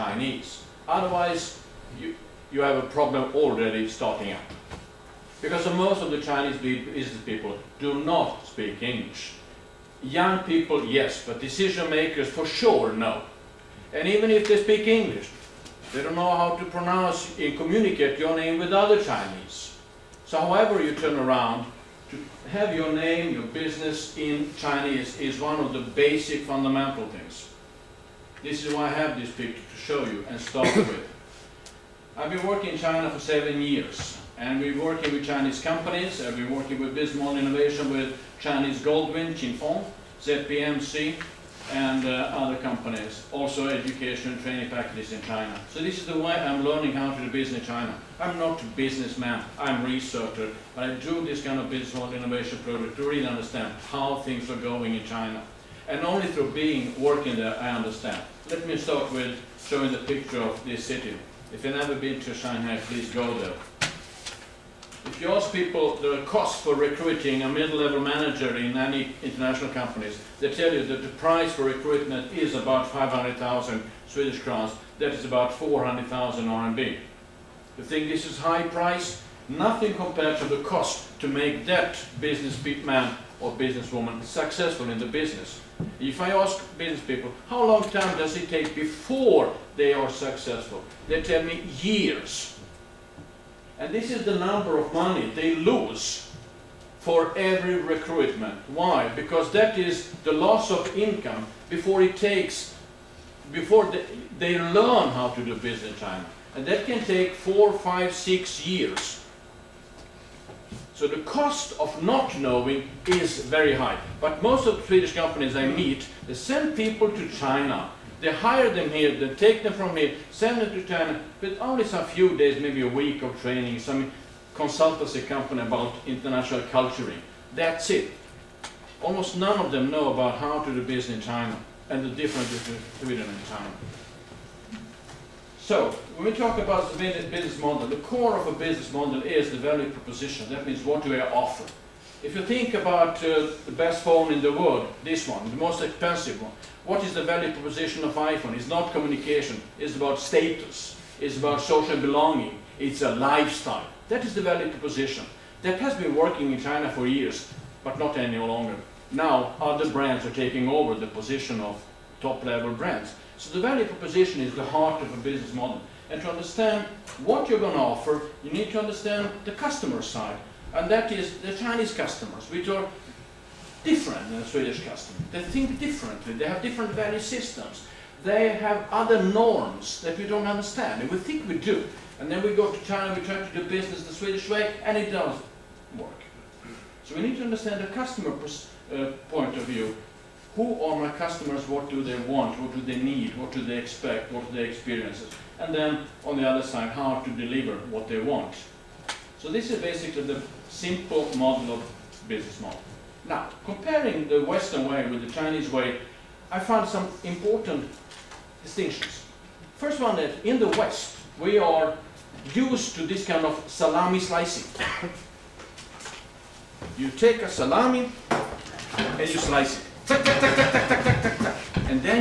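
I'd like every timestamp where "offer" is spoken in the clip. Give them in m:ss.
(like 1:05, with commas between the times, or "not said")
2:21, 2:47.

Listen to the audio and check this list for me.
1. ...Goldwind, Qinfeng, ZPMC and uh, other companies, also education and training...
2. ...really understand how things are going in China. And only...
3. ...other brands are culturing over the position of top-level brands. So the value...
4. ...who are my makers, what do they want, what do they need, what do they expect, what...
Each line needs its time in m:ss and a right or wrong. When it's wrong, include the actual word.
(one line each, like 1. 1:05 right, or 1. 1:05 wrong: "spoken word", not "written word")
1. 0:38 right
2. 0:53 right
3. 2:39 wrong: "taking", not "culturing"
4. 3:10 wrong: "customers", not "makers".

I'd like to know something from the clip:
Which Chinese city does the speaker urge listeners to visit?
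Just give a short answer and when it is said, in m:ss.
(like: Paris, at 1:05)
Shanghai, at 1:02.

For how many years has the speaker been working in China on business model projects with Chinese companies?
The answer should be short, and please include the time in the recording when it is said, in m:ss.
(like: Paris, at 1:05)
7, at 0:33.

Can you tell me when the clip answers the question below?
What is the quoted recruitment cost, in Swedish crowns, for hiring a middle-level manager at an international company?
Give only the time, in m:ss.
1:12.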